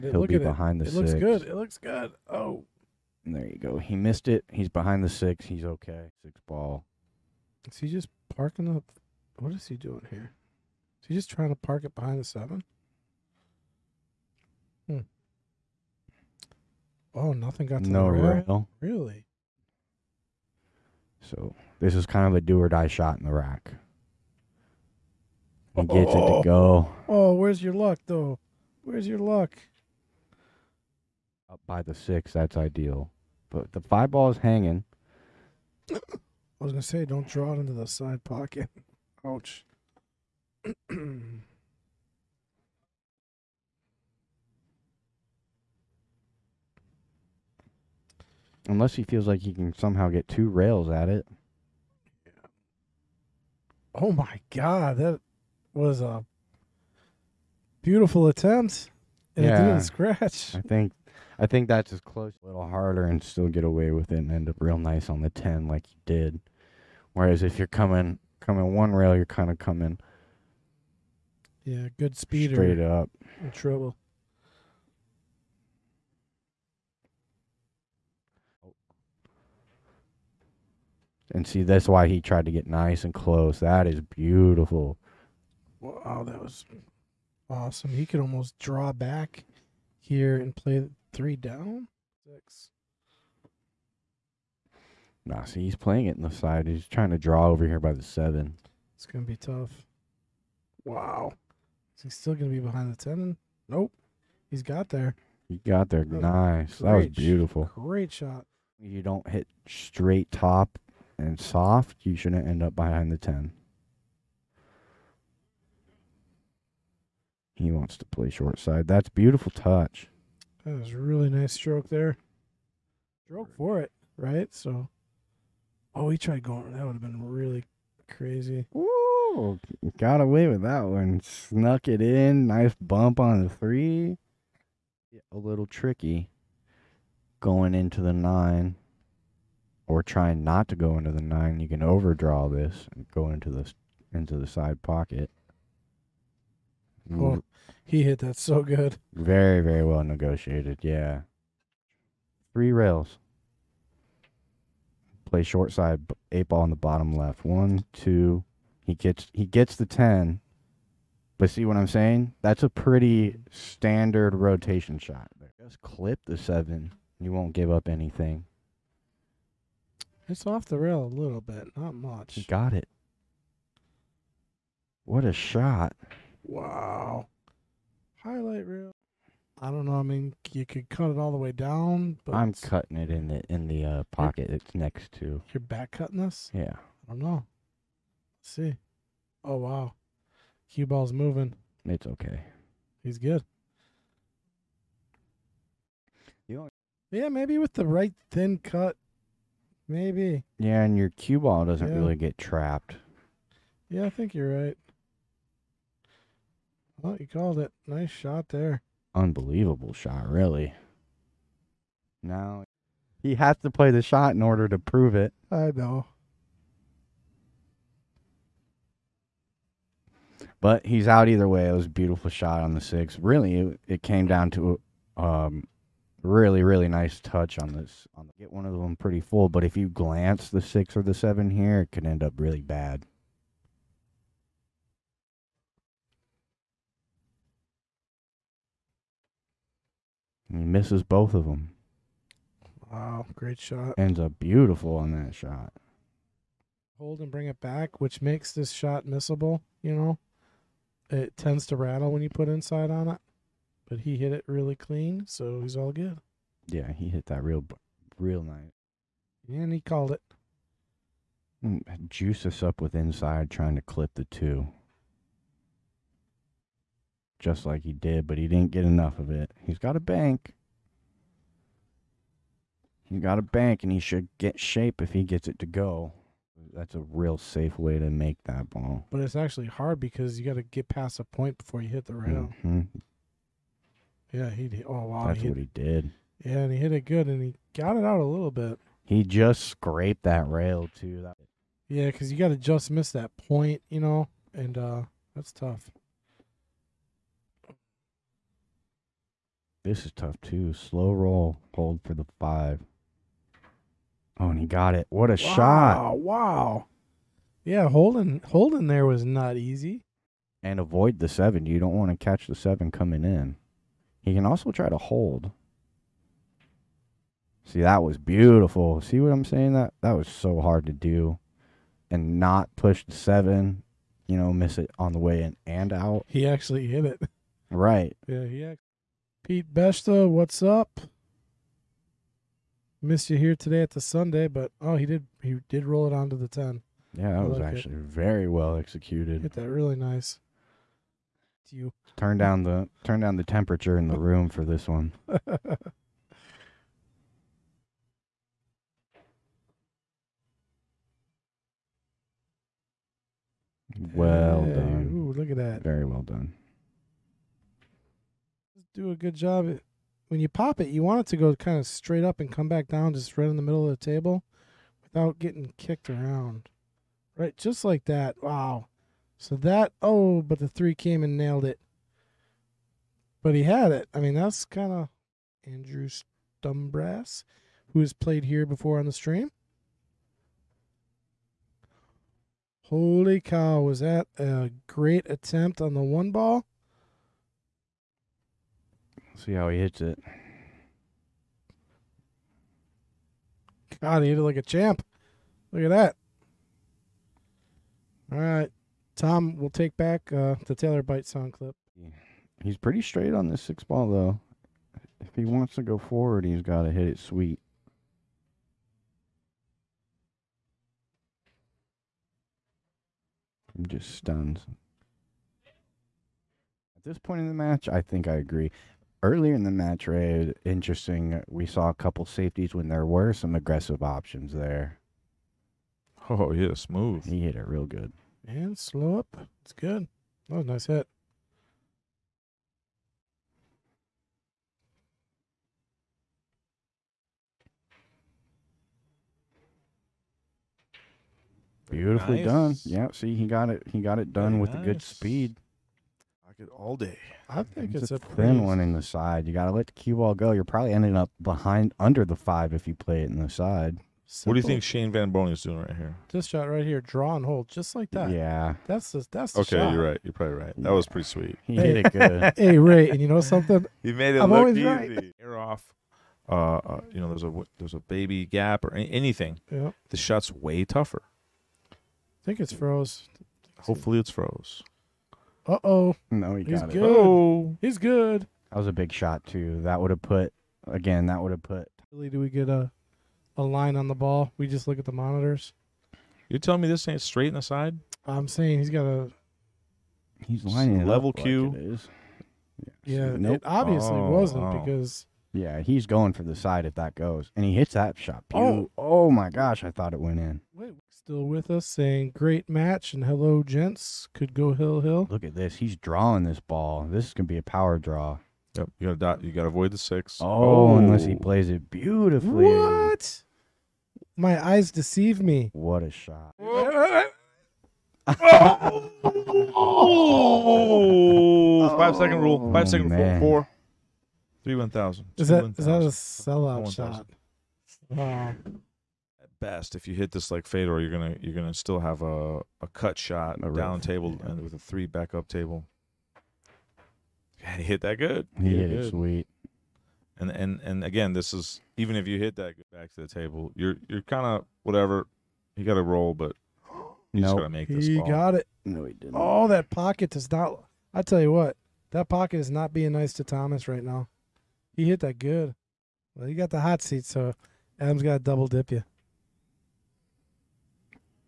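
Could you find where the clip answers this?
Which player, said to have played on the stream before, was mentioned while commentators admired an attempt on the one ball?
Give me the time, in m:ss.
6:15.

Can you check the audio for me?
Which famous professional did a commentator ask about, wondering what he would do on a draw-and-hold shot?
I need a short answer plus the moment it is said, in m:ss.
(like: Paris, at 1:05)
Shane Van Boening, at 7:34.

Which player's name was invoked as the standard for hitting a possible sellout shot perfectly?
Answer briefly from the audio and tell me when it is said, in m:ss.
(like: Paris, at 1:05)
Fedor, at 8:50.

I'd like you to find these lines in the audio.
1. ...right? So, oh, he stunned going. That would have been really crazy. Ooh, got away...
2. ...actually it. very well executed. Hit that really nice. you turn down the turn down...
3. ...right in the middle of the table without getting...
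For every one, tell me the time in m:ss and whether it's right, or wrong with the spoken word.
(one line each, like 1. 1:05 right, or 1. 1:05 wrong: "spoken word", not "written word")
1. 2:04 wrong: "tried", not "stunned"
2. 5:37 right
3. 6:03 right.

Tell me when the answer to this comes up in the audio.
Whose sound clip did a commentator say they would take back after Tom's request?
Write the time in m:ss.
6:40.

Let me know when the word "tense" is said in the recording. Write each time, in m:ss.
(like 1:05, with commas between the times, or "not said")
not said.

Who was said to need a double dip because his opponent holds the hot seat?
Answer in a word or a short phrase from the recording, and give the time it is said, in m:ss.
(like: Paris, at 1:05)
Adam, at 9:17.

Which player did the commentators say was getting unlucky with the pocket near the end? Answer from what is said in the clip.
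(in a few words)
Thomas.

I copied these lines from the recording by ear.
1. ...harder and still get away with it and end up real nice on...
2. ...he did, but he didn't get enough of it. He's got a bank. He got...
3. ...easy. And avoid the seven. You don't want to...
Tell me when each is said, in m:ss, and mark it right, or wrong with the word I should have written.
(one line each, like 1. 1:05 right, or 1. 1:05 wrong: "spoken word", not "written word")
1. 1:02 right
2. 4:27 right
3. 5:09 right.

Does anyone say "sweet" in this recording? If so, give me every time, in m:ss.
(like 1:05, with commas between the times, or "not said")
6:47, 7:41, 8:59.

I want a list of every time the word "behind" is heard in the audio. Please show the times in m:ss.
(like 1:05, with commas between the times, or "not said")
0:00, 0:04, 0:11, 1:42, 1:52, 7:31.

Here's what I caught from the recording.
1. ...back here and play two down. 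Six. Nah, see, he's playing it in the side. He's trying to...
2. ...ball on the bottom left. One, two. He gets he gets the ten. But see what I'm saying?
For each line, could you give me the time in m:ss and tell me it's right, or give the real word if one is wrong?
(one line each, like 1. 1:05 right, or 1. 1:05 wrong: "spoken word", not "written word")
1. 1:28 wrong: "three", not "two"
2. 2:36 right.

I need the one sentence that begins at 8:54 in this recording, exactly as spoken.
and with a three backup table.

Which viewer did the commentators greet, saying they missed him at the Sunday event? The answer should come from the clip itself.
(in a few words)
Pete Beshta.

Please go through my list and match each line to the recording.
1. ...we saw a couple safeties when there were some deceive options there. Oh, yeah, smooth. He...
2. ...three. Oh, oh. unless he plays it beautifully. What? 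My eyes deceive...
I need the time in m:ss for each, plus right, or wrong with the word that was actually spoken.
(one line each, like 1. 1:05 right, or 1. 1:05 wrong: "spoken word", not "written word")
1. 7:01 wrong: "aggressive", not "deceive"
2. 8:29 wrong: "six", not "three".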